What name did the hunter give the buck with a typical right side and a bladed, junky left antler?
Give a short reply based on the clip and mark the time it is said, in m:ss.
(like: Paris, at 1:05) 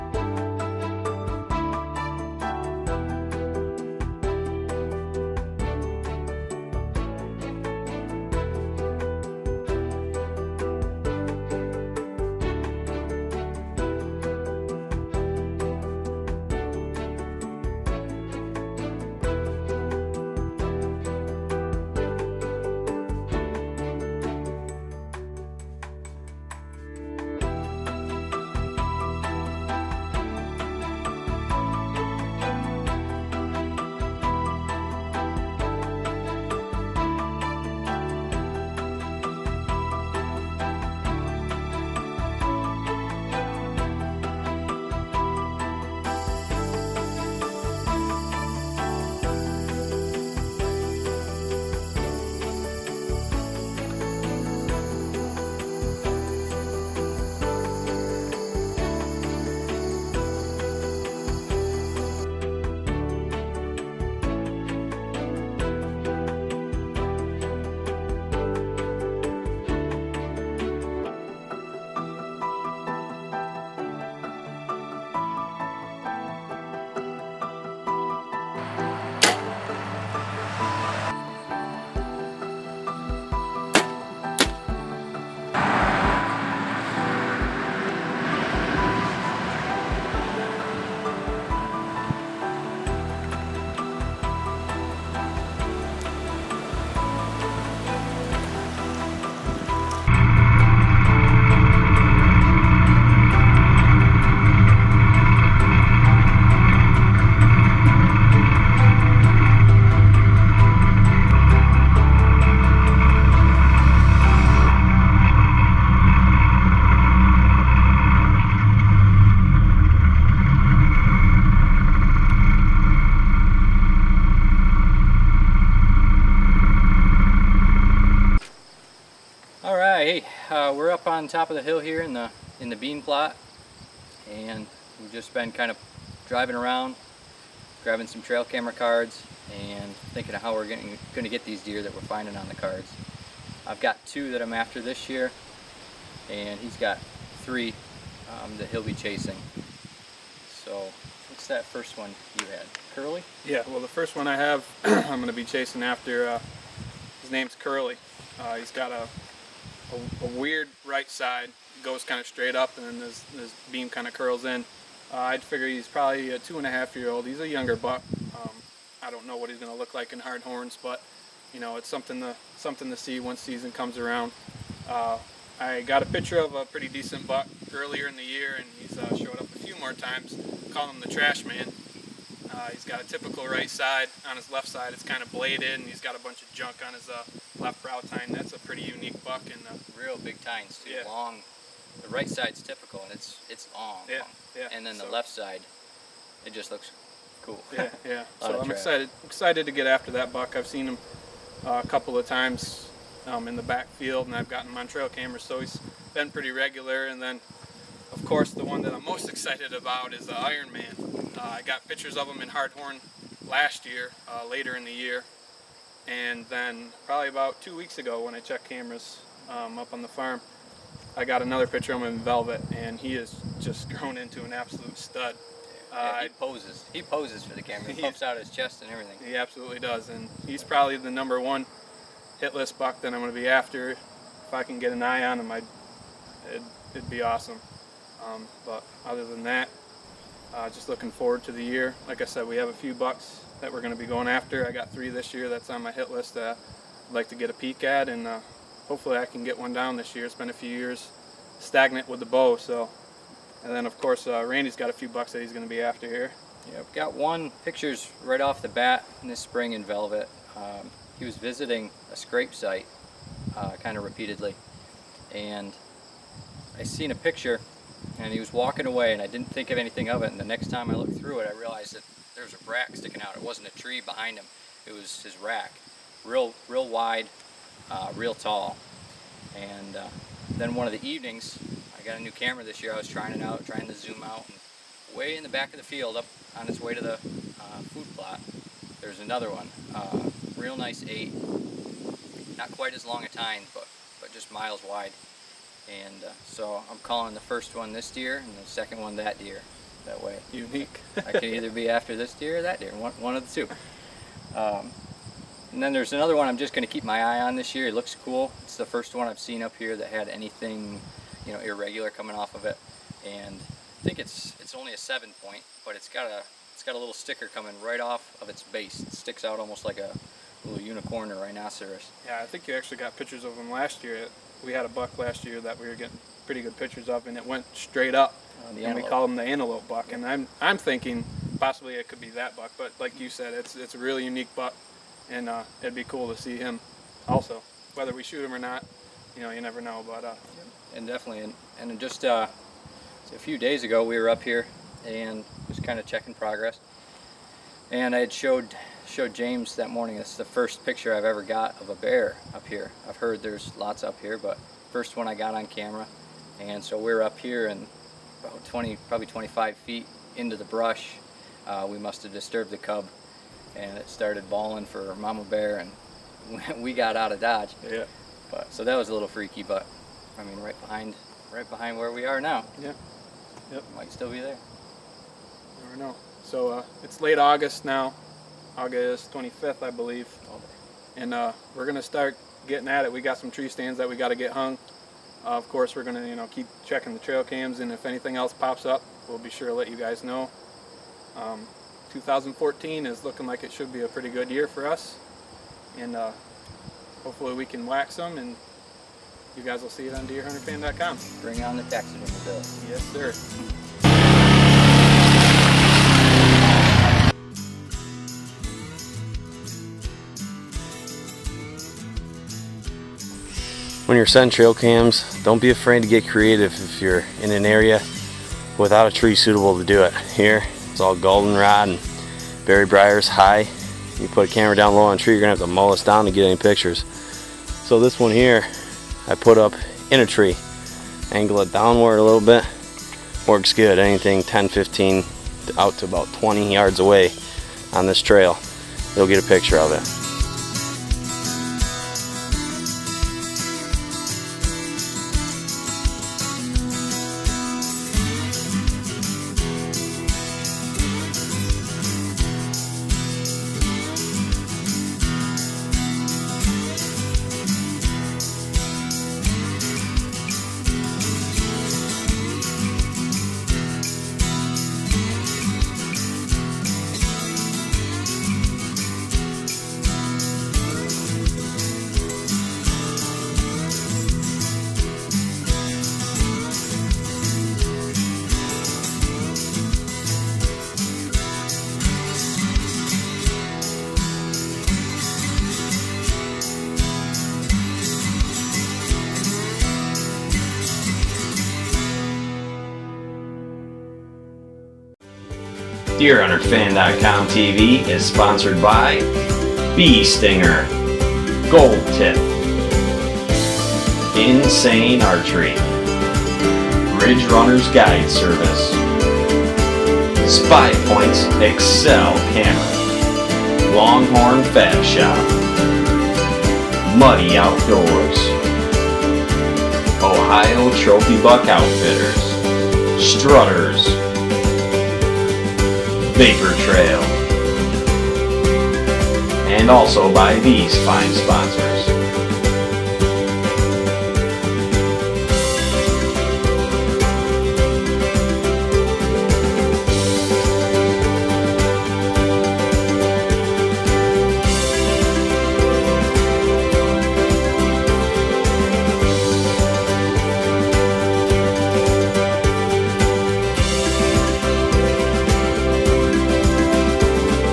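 Trash Man, at 3:01.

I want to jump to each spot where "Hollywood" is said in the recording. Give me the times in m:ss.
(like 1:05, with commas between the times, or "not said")
not said.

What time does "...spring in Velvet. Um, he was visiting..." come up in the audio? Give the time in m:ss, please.
4:19.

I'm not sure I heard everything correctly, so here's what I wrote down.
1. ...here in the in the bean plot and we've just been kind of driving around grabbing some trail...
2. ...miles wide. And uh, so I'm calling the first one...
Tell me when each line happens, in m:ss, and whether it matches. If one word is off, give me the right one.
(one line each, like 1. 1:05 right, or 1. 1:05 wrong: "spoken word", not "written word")
1. 2:11 right
2. 4:54 right.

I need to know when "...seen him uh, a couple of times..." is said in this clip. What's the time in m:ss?
3:20.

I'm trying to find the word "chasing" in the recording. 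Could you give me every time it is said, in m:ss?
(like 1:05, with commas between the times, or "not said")
2:28, 2:35.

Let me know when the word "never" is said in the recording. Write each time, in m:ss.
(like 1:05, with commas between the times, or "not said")
5:39, 6:15.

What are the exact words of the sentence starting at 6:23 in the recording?
We got some tree stands that we got to get hung.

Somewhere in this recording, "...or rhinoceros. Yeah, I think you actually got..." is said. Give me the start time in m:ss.
5:21.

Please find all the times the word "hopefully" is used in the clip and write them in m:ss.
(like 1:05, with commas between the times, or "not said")
4:08, 6:37.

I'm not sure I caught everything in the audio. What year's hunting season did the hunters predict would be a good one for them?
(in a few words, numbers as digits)
2014.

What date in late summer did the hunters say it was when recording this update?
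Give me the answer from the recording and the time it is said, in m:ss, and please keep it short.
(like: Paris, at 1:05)
August 25th, at 6:18.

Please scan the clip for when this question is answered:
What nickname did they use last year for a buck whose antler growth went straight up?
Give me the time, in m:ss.
5:29.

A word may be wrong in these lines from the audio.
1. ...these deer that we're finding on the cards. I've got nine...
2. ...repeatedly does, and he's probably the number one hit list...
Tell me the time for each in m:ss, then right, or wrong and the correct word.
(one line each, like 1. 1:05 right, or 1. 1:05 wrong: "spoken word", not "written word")
1. 2:21 wrong: "two", not "nine"
2. 3:49 wrong: "absolutely", not "repeatedly".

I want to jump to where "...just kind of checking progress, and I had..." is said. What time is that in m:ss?
5:45.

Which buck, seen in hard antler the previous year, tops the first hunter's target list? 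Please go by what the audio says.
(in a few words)
Iron Man.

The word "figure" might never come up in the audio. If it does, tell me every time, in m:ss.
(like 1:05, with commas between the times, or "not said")
2:45.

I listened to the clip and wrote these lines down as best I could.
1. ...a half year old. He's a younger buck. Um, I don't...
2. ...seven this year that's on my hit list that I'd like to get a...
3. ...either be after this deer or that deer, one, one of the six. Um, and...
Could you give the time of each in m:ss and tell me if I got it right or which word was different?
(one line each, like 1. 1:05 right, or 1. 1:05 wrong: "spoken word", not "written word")
1. 2:46 right
2. 4:04 wrong: "three", not "seven"
3. 5:01 wrong: "two", not "six".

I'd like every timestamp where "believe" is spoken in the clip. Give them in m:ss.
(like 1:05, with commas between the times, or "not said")
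6:19.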